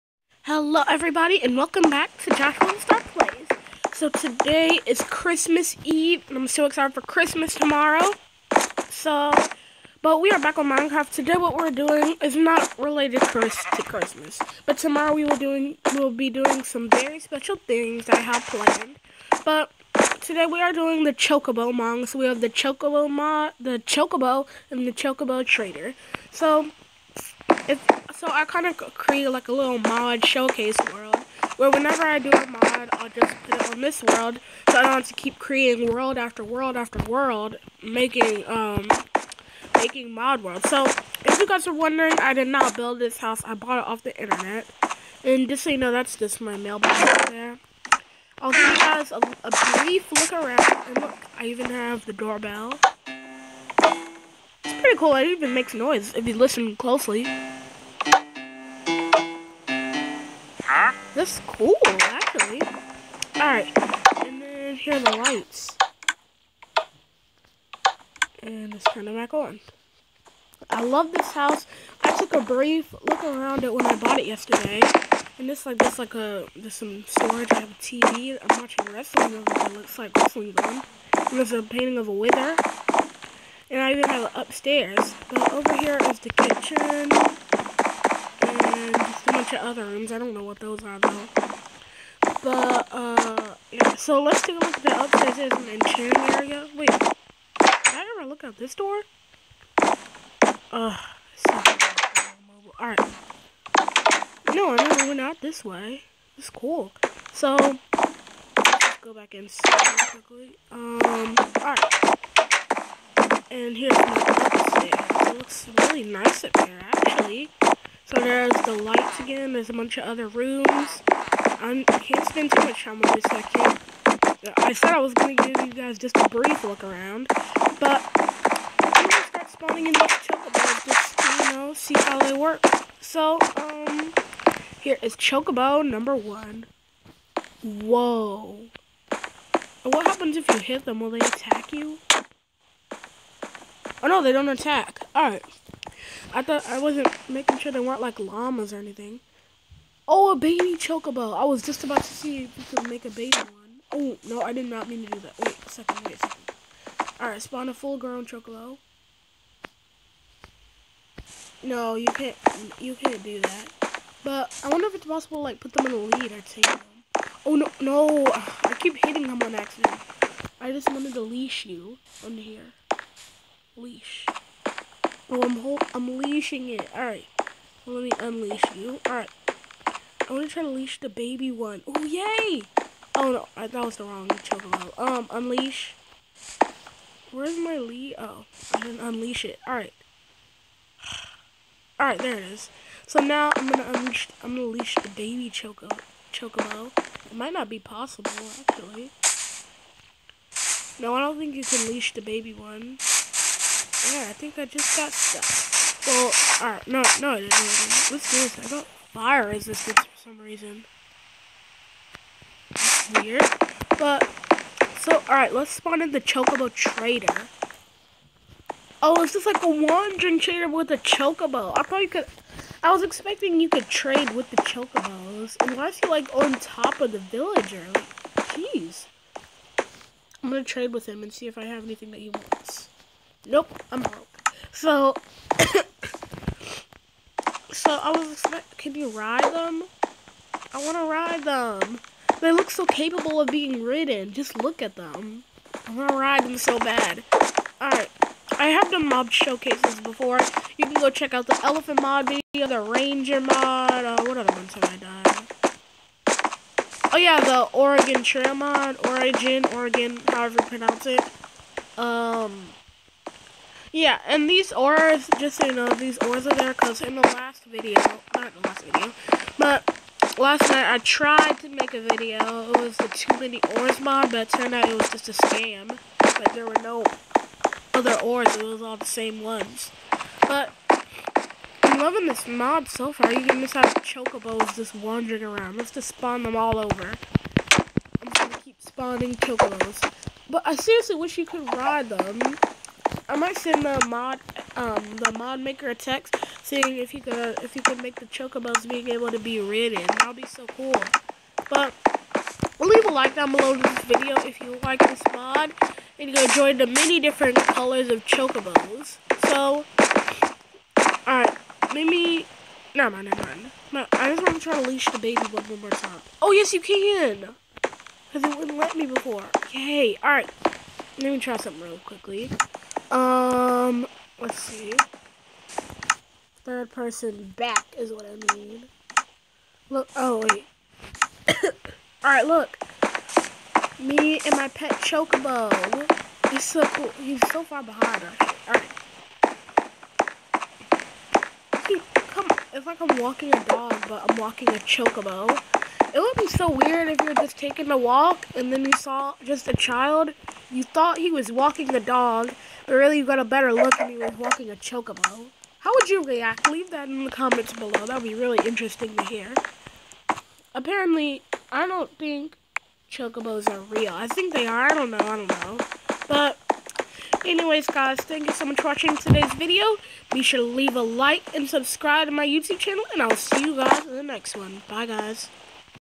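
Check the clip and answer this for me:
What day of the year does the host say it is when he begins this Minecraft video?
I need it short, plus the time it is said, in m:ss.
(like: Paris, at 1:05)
Christmas Eve, at 0:05.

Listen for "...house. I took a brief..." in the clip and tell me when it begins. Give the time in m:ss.
1:11.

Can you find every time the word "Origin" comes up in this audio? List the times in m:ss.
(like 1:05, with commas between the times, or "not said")
4:19.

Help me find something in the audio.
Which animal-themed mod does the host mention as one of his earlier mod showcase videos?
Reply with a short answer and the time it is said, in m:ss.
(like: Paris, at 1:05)
Elephant mod, at 4:11.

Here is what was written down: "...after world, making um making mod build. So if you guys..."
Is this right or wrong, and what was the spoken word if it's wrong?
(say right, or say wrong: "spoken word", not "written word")
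wrong: "world", not "build".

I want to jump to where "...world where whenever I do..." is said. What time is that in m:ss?
0:30.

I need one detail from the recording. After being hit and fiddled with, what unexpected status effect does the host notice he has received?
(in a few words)
Fire resistance.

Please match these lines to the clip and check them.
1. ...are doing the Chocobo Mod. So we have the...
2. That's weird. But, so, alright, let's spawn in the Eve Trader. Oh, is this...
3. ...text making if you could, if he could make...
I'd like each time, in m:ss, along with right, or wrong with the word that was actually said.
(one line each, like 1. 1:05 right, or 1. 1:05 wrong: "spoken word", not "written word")
1. 0:20 right
2. 3:32 wrong: "Chocobo", not "Eve"
3. 4:55 wrong: "saying", not "making".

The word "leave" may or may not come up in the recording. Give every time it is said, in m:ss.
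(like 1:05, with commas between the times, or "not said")
5:02, 5:56, 6:10.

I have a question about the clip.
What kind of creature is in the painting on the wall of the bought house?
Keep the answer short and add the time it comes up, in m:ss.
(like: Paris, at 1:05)
A wither, at 1:22.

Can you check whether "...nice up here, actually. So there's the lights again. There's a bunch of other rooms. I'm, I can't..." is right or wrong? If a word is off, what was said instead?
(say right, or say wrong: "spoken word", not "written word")
right.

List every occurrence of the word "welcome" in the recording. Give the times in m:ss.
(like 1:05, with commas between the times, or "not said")
0:01.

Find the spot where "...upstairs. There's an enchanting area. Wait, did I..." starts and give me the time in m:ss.
1:35.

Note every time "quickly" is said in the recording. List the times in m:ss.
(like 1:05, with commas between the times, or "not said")
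1:50, 5:21.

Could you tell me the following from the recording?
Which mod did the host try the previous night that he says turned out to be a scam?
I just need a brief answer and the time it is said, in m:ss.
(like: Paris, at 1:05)
Too Many Ores, at 4:33.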